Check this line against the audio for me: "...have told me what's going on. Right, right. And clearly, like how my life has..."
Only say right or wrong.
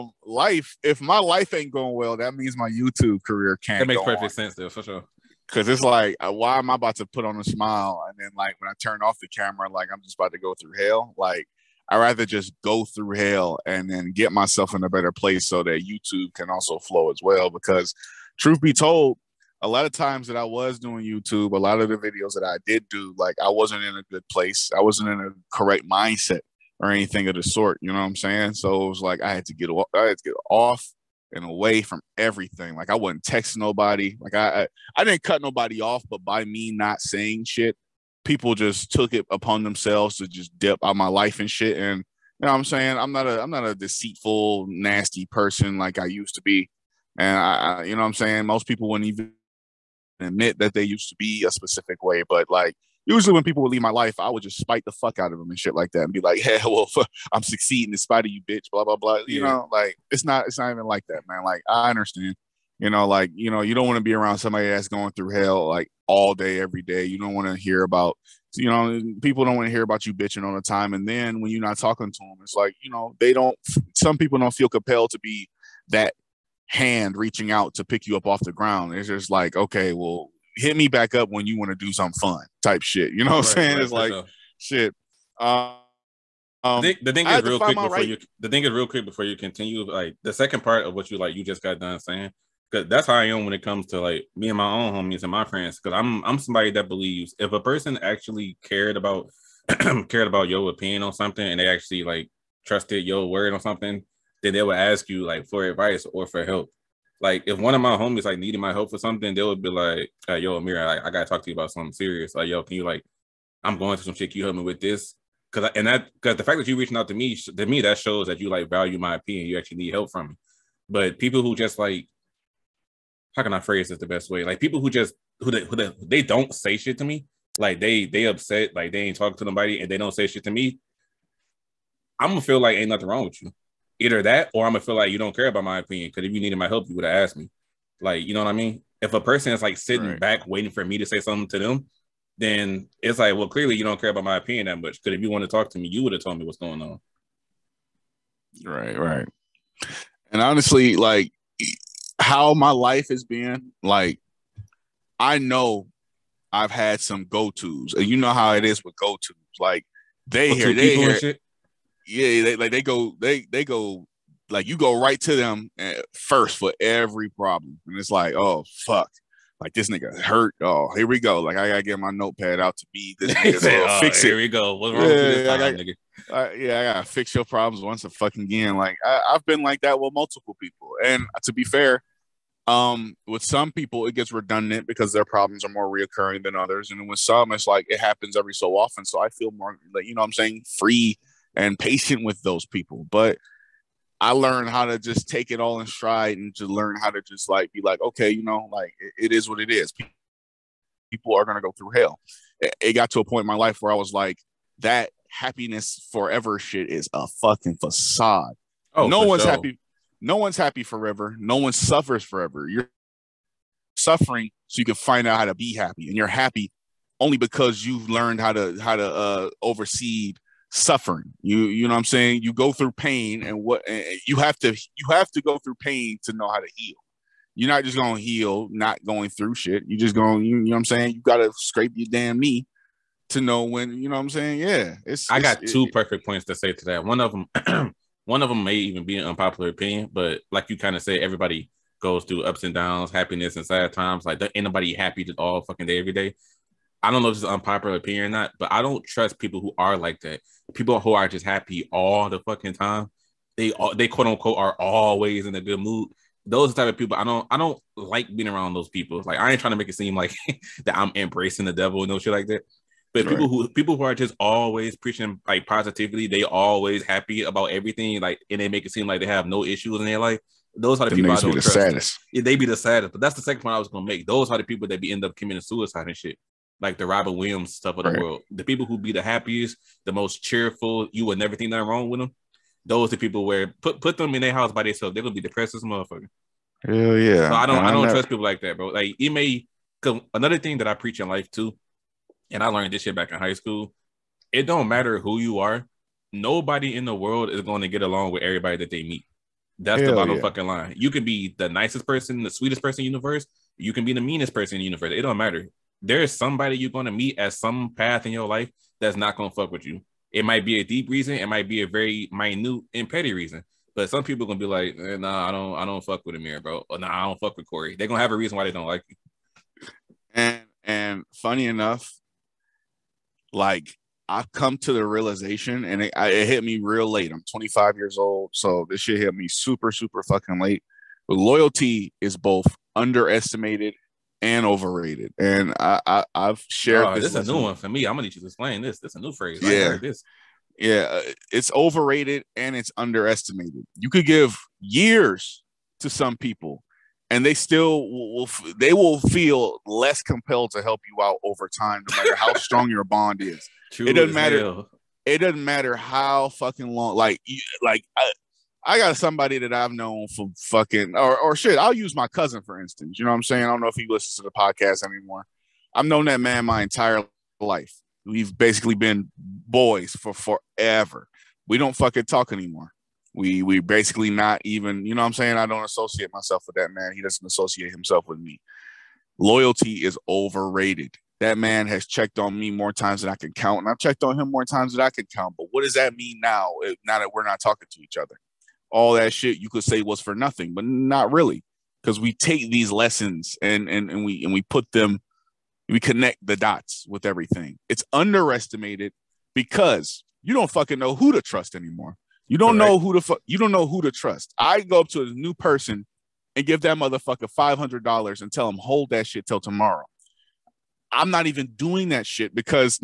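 wrong.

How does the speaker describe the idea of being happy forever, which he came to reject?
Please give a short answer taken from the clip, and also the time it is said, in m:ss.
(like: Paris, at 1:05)
facade, at 3:27.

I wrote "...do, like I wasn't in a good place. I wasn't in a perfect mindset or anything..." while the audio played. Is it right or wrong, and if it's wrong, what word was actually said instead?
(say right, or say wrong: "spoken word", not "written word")
wrong: "correct", not "perfect".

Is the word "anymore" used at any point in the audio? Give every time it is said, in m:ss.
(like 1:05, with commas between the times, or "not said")
6:05, 6:12, 6:41.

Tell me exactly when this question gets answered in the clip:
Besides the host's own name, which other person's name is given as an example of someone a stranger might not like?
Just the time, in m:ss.
5:17.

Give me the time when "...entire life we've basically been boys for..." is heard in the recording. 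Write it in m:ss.
6:06.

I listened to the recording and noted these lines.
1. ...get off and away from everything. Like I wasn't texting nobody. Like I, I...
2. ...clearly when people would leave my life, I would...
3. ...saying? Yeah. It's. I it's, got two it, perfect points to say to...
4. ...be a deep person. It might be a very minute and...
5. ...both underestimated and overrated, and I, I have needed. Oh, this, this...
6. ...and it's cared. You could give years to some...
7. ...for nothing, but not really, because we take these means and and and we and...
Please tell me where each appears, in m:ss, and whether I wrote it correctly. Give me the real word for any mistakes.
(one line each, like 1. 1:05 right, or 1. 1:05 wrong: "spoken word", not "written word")
1. 0:30 right
2. 0:53 wrong: "usually", not "clearly"
3. 3:54 right
4. 5:10 wrong: "reason", not "person"
5. 5:32 wrong: "shared", not "needed"
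6. 5:42 wrong: "underestimated", not "cared"
7. 6:30 wrong: "lessons", not "means".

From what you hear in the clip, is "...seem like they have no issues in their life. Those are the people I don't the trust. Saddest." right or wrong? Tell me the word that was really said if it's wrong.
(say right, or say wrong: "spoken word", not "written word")
right.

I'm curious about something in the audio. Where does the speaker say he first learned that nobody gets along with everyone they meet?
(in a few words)
high school.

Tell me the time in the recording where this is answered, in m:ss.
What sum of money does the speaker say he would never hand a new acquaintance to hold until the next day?
6:47.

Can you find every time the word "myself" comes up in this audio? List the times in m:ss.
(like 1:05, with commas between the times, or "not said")
0:14, 6:16.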